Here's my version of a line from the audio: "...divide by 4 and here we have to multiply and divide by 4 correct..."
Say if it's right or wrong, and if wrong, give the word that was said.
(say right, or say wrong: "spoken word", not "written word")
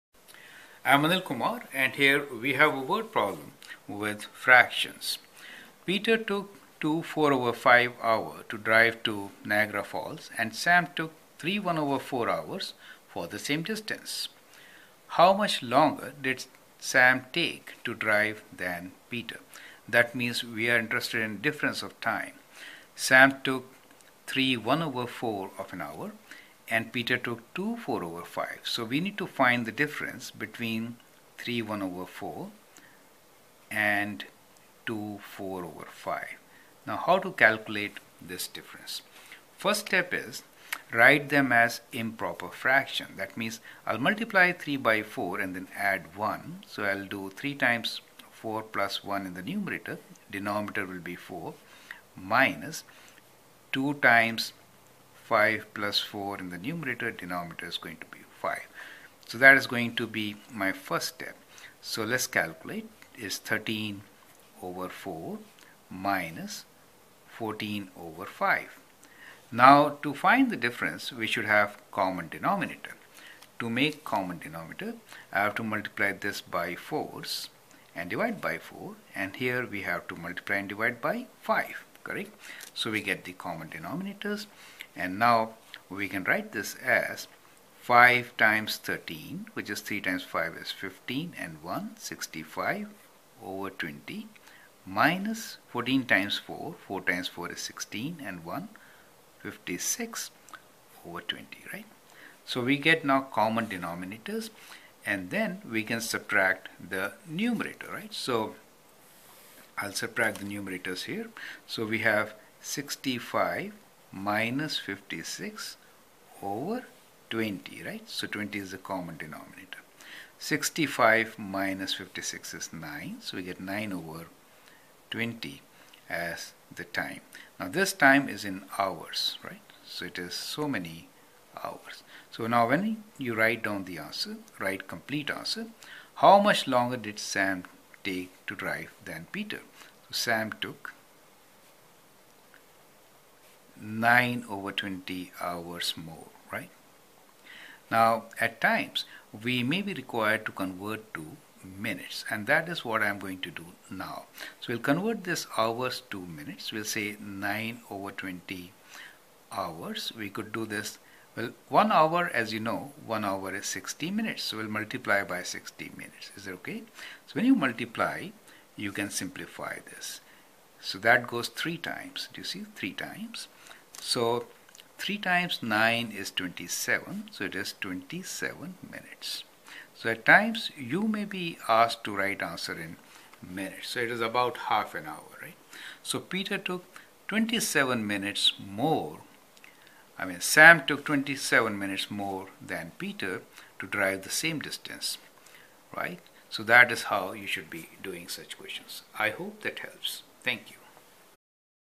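wrong: "5", not "4".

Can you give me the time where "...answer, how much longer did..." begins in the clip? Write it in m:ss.
2:15.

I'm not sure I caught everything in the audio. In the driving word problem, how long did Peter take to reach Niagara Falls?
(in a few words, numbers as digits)
2 4/5 hours.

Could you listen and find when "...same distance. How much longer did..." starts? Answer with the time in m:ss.
0:13.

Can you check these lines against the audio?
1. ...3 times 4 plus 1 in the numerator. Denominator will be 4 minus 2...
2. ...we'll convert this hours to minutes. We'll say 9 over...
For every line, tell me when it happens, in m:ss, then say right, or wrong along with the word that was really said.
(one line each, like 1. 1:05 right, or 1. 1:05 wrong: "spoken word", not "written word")
1. 0:47 right
2. 2:34 right.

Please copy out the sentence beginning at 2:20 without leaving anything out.
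So Sam took 9 over 20 hours more, right?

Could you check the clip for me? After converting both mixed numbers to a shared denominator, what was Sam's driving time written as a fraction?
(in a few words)
65/20.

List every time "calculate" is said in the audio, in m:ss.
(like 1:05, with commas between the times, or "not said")
0:37, 1:02.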